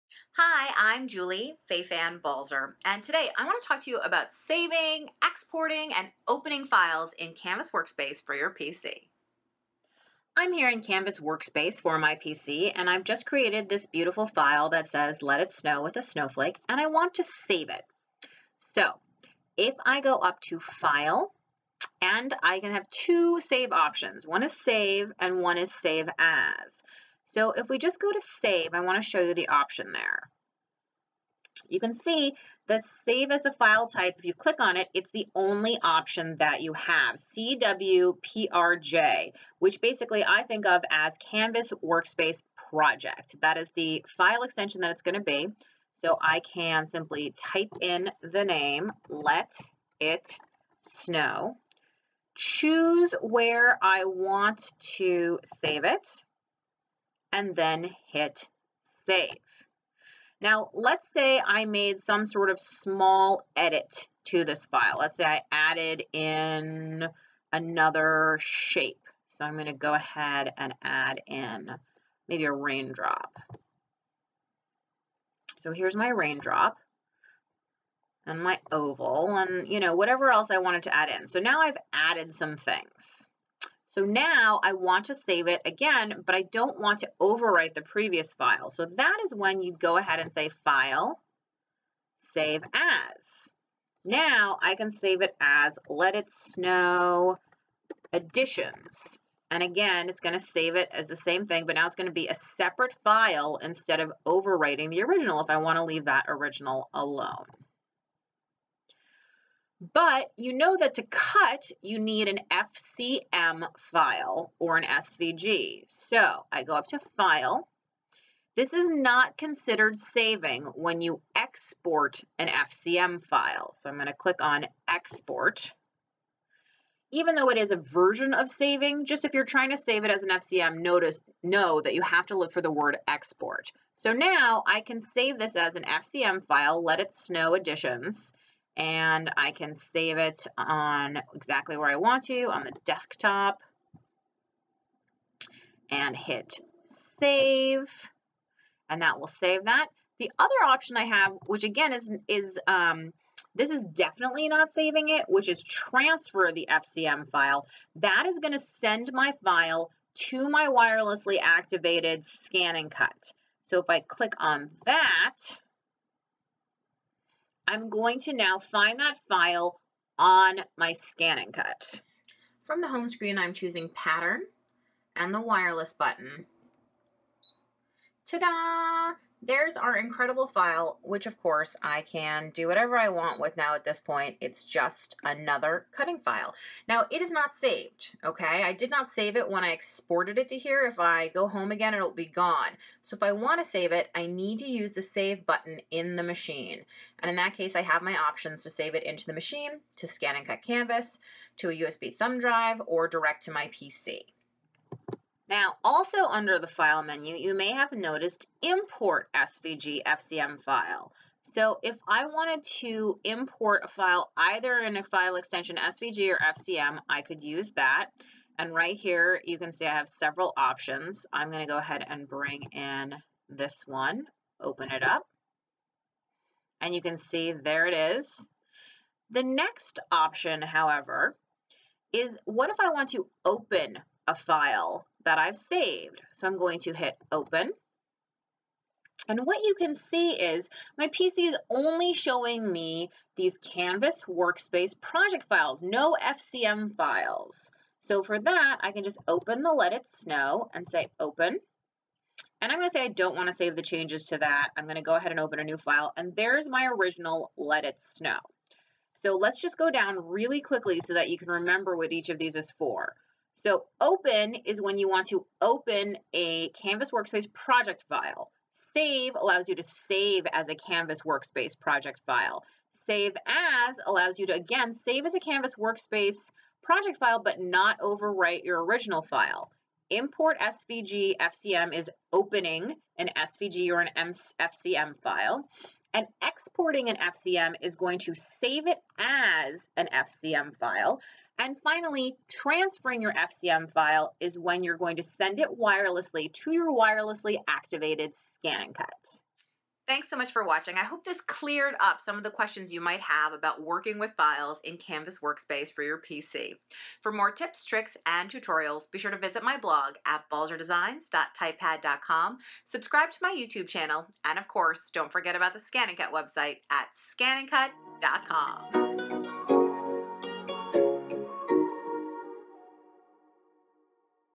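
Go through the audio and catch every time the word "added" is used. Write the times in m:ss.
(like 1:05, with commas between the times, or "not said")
1:05, 1:21.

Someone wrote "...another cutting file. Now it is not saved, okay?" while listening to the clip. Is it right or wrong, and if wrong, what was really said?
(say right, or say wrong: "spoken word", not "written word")
right.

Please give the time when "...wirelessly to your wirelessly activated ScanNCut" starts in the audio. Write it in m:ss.
4:55.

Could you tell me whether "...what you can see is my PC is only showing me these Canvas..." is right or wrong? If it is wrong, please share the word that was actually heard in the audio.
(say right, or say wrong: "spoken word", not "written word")
right.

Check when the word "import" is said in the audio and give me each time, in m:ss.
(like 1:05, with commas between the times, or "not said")
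3:28, 3:33, 4:40.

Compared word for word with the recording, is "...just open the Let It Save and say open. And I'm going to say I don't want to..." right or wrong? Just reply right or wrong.
wrong.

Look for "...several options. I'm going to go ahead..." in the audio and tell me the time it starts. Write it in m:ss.
3:40.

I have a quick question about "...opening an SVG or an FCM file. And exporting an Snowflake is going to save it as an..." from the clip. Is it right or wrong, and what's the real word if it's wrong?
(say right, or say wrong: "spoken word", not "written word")
wrong: "FCM", not "Snowflake".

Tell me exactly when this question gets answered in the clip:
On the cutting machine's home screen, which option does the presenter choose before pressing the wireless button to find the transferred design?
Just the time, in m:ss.
2:53.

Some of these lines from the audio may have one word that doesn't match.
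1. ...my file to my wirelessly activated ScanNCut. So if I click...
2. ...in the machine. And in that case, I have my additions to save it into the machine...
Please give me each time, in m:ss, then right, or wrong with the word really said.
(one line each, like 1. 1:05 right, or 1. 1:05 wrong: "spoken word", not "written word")
1. 2:39 right
2. 3:15 wrong: "options", not "additions".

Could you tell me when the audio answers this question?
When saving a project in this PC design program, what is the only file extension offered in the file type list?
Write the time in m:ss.
0:37.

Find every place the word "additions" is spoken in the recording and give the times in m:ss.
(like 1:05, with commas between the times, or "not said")
1:38, 2:17.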